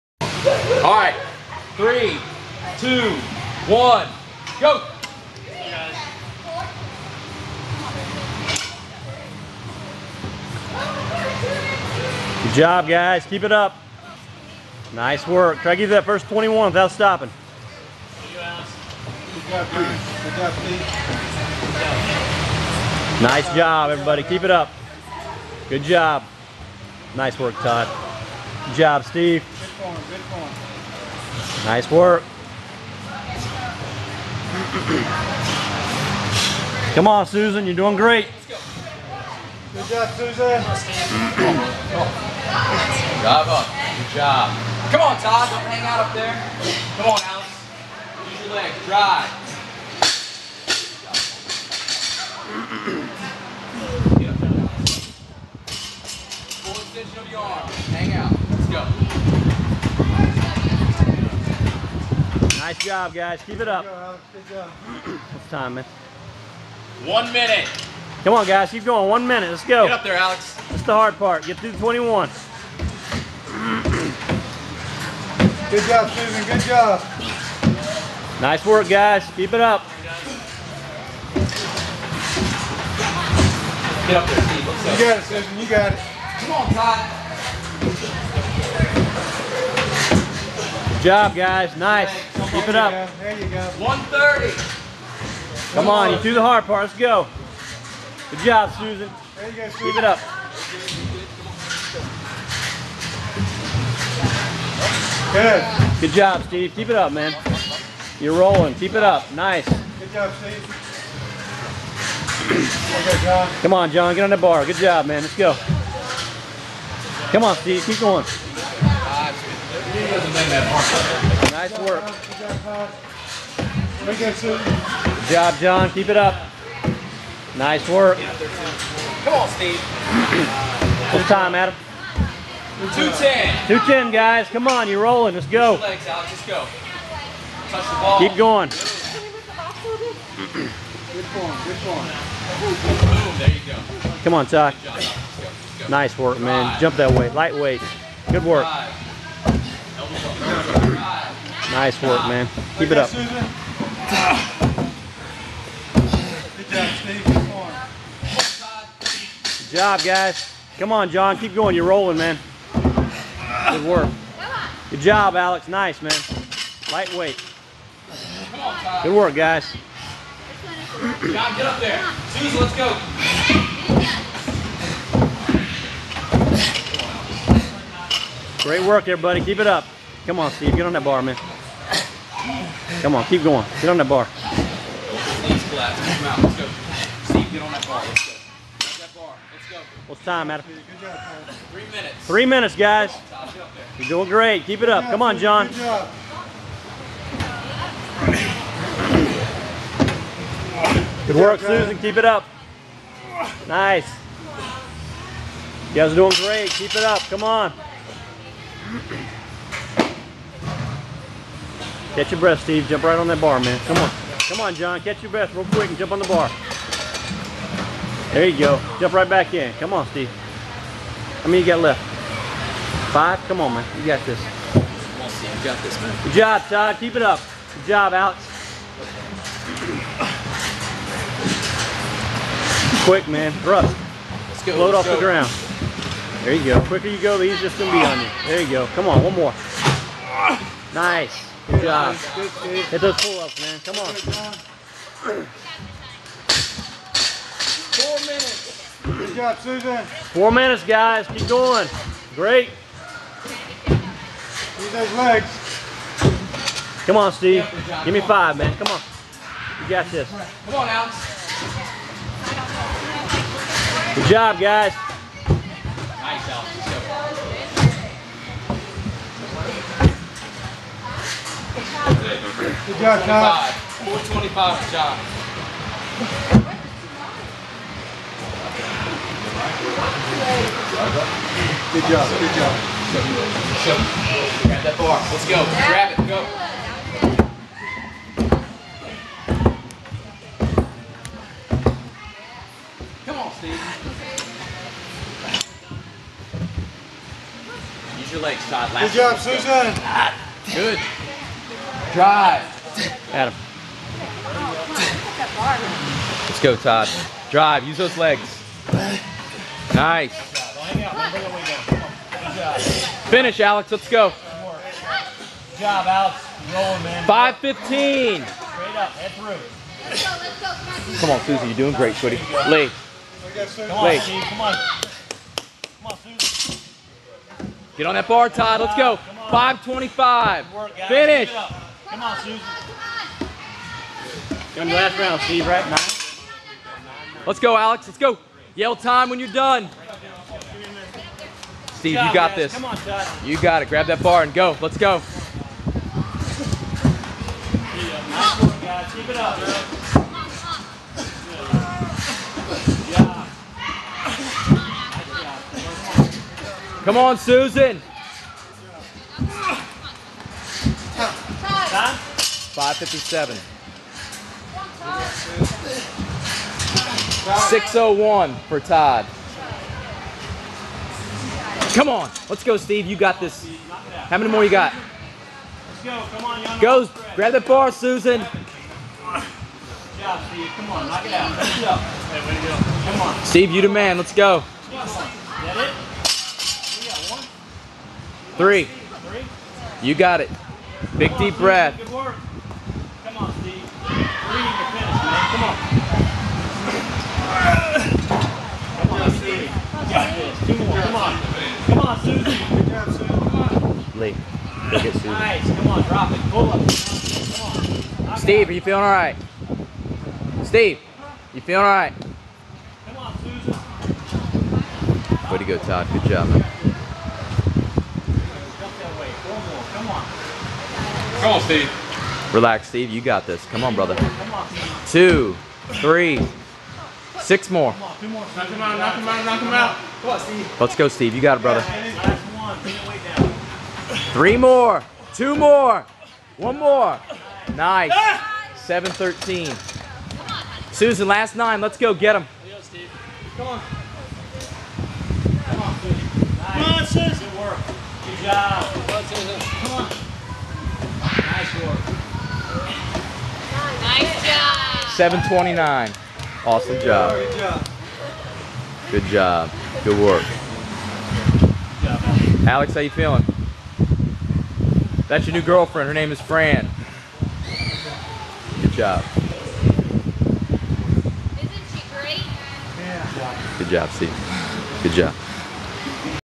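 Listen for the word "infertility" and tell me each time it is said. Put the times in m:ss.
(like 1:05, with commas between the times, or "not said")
not said.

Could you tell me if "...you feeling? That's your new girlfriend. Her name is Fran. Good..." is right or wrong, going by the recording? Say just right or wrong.
right.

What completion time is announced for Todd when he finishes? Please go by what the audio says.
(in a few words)
6:01.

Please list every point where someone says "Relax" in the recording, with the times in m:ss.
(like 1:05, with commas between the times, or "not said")
7:02.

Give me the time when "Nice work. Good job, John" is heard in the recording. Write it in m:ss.
2:01.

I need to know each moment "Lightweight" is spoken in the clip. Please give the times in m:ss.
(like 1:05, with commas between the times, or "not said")
2:27, 2:46.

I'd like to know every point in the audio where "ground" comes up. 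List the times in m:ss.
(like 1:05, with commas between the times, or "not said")
3:55.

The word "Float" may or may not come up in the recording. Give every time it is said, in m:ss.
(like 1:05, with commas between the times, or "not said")
3:54.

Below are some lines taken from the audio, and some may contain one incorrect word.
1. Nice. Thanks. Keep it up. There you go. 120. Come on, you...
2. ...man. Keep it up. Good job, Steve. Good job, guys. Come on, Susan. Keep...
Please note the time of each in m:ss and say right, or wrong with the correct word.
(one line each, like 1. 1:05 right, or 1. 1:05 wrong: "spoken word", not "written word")
1. 1:31 wrong: "130", not "120"
2. 2:32 wrong: "John", not "Susan".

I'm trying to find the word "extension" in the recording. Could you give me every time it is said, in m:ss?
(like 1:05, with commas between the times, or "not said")
0:56.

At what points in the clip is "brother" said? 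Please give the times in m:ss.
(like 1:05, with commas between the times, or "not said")
7:03, 7:11.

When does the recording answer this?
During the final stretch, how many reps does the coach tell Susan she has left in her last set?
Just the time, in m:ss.
7:20.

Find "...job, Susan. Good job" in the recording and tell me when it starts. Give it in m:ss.
1:15.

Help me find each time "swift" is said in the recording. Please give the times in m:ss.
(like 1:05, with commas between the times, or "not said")
not said.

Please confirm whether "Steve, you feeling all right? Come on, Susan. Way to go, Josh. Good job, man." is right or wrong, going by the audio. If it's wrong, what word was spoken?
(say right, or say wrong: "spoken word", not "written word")
wrong: "Todd", not "Josh".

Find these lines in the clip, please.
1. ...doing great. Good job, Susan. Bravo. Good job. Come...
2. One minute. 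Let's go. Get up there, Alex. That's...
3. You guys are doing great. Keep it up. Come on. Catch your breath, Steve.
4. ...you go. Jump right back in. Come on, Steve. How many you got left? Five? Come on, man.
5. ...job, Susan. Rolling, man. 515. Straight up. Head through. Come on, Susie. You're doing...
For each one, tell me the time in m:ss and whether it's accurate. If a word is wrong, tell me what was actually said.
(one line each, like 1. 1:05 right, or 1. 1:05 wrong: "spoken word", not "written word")
1. 0:37 right
2. 1:09 right
3. 3:25 right
4. 3:38 right
5. 5:15 wrong: "Alex", not "Susan".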